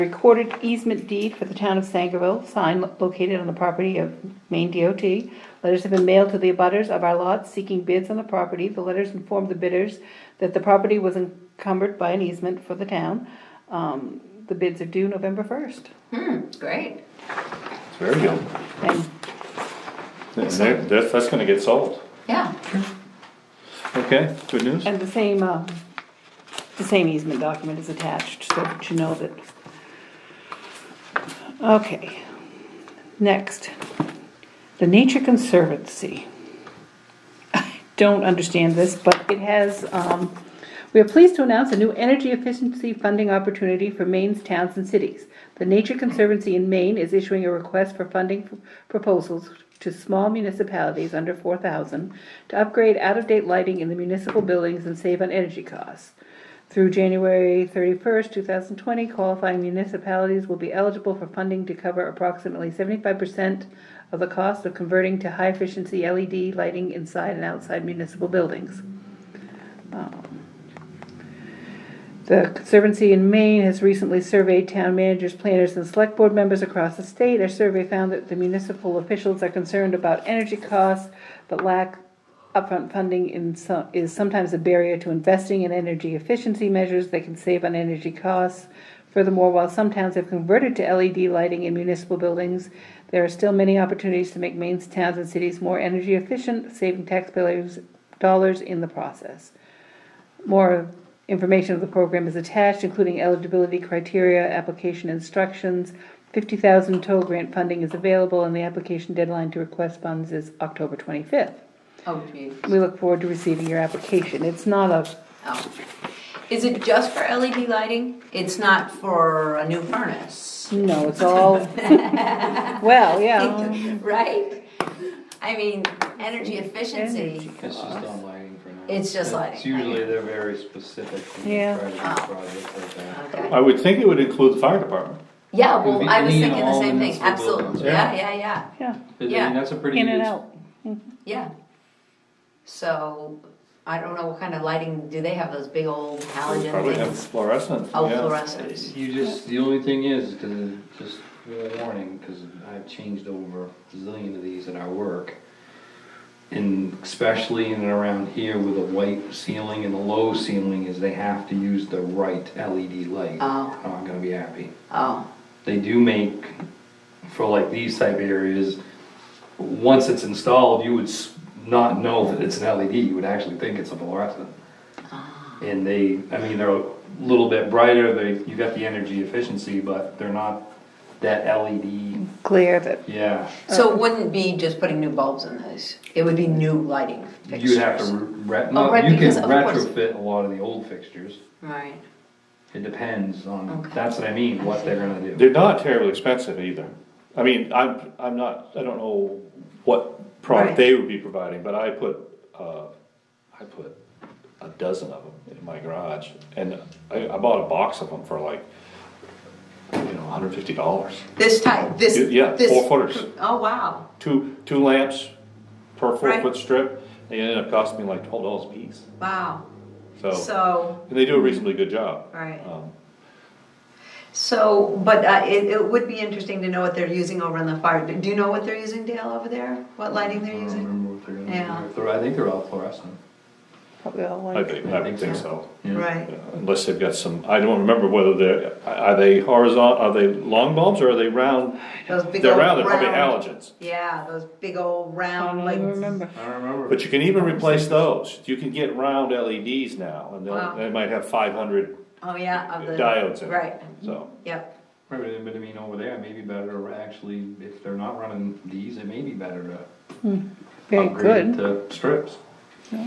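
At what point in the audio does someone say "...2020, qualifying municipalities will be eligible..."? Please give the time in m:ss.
0:58.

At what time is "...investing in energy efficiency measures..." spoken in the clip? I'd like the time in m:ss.
1:25.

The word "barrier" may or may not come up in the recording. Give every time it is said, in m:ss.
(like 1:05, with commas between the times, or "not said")
1:24.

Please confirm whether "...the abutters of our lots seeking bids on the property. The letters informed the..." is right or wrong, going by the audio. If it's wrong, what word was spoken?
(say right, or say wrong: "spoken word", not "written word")
right.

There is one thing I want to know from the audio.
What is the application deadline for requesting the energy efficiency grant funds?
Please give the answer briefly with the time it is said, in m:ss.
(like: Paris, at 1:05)
October 25, at 1:50.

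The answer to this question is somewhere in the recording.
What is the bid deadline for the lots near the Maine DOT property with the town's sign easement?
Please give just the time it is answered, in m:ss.
0:15.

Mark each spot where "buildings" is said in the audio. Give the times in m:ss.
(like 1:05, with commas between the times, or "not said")
0:54, 1:08, 1:32.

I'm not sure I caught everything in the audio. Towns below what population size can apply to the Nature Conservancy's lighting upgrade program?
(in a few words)
4,000.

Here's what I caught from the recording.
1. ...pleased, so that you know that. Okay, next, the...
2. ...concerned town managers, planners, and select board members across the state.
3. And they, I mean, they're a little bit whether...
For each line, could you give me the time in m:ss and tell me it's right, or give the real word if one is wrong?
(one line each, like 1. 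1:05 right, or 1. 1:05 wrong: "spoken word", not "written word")
1. 0:27 wrong: "attached", not "pleased"
2. 1:14 wrong: "surveyed", not "concerned"
3. 2:55 wrong: "brighter", not "whether".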